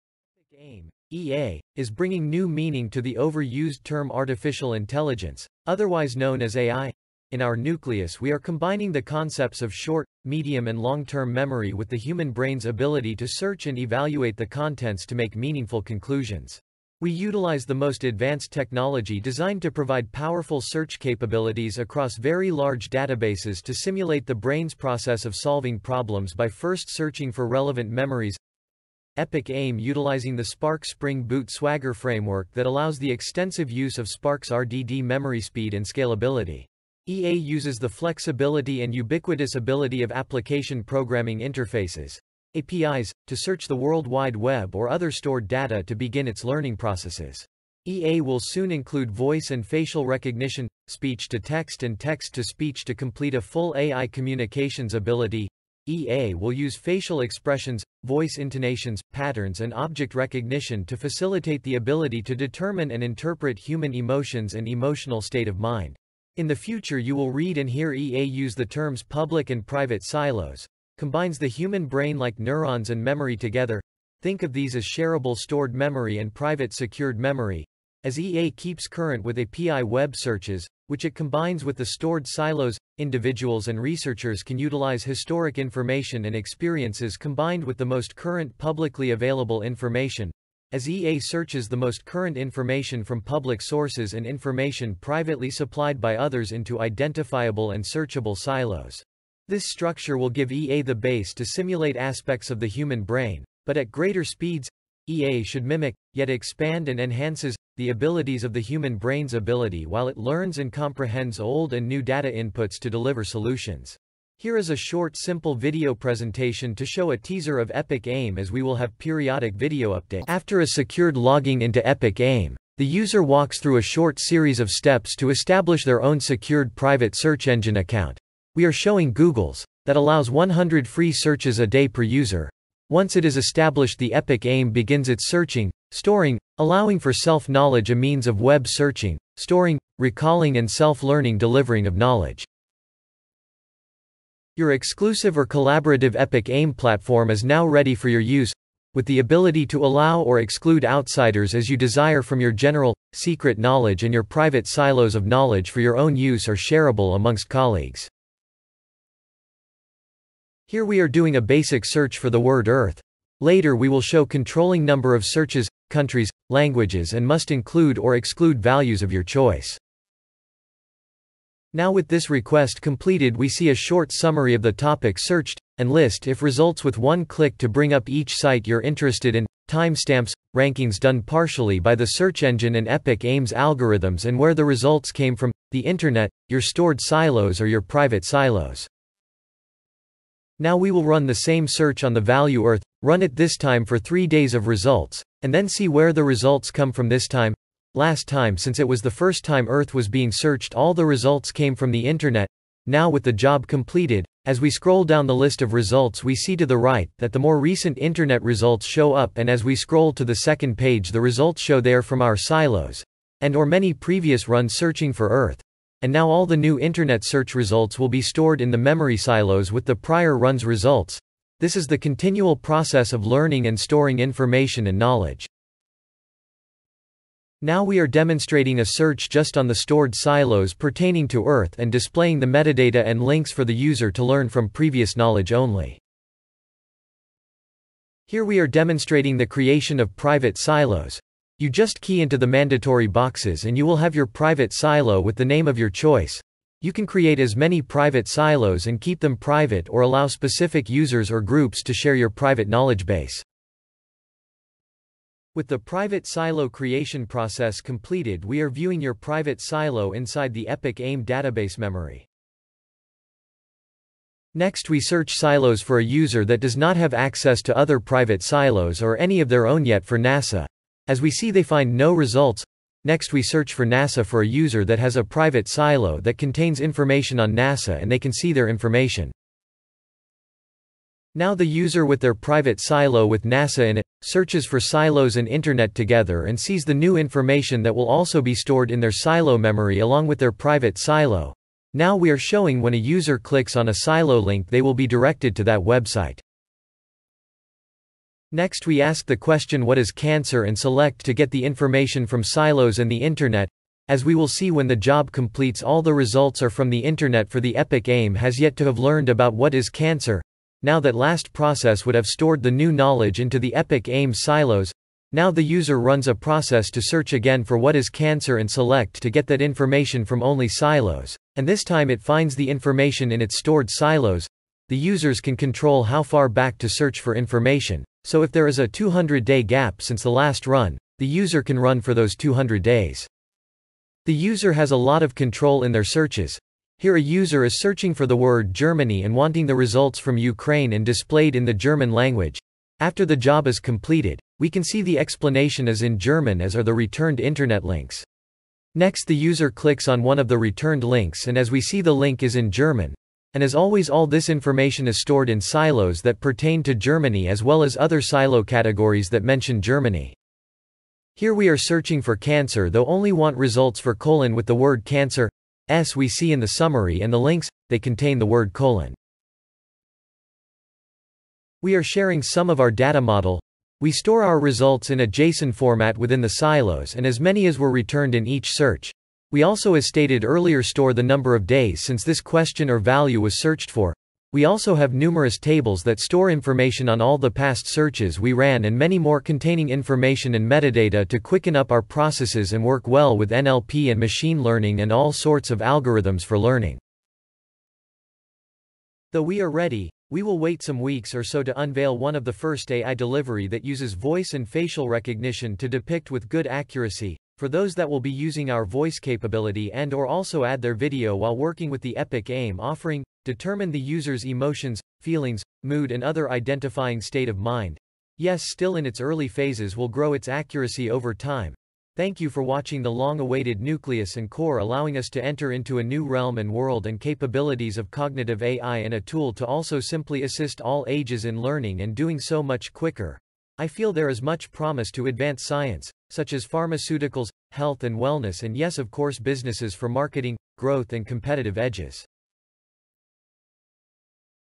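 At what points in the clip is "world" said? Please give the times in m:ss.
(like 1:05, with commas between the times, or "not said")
0:43, 7:06.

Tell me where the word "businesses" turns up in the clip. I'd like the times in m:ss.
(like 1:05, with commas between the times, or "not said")
7:19.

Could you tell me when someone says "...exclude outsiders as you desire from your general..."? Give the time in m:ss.
2:30.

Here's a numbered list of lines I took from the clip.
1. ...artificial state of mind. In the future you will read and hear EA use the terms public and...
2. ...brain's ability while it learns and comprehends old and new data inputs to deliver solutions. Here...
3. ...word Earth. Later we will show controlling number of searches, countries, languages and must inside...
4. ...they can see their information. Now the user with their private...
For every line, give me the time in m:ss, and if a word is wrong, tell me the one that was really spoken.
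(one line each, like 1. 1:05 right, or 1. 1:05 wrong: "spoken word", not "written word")
1. 1:04 wrong: "emotional", not "artificial"
2. 1:48 right
3. 2:42 wrong: "include", not "inside"
4. 4:38 right.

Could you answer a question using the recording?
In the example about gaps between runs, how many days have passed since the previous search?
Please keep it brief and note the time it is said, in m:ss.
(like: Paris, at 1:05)
200, at 5:28.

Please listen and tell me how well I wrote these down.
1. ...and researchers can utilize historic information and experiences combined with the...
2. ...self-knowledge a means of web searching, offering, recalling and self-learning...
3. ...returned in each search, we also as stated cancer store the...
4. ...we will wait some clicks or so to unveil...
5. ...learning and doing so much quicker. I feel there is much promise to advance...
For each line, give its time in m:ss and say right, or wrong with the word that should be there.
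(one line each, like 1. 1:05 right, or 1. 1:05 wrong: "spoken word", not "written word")
1. 1:23 right
2. 2:17 wrong: "storing", not "offering"
3. 6:17 wrong: "earlier", not "cancer"
4. 6:40 wrong: "weeks", not "clicks"
5. 7:11 right.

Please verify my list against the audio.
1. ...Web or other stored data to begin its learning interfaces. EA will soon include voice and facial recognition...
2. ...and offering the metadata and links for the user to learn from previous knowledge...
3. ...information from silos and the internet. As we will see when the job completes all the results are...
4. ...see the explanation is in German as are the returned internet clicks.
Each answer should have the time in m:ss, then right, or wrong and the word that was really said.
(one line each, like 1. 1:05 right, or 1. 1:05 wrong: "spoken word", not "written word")
1. 0:44 wrong: "processes", not "interfaces"
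2. 3:51 wrong: "displaying", not "offering"
3. 5:01 right
4. 5:44 wrong: "links", not "clicks".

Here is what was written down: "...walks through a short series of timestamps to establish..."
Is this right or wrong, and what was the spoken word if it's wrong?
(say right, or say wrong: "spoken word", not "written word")
wrong: "steps", not "timestamps".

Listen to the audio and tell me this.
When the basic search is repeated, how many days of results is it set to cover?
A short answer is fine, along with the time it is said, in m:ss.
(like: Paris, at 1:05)
3, at 3:13.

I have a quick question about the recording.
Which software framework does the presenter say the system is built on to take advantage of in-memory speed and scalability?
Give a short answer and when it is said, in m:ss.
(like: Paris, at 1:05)
Spark Spring Boot Swagger, at 0:30.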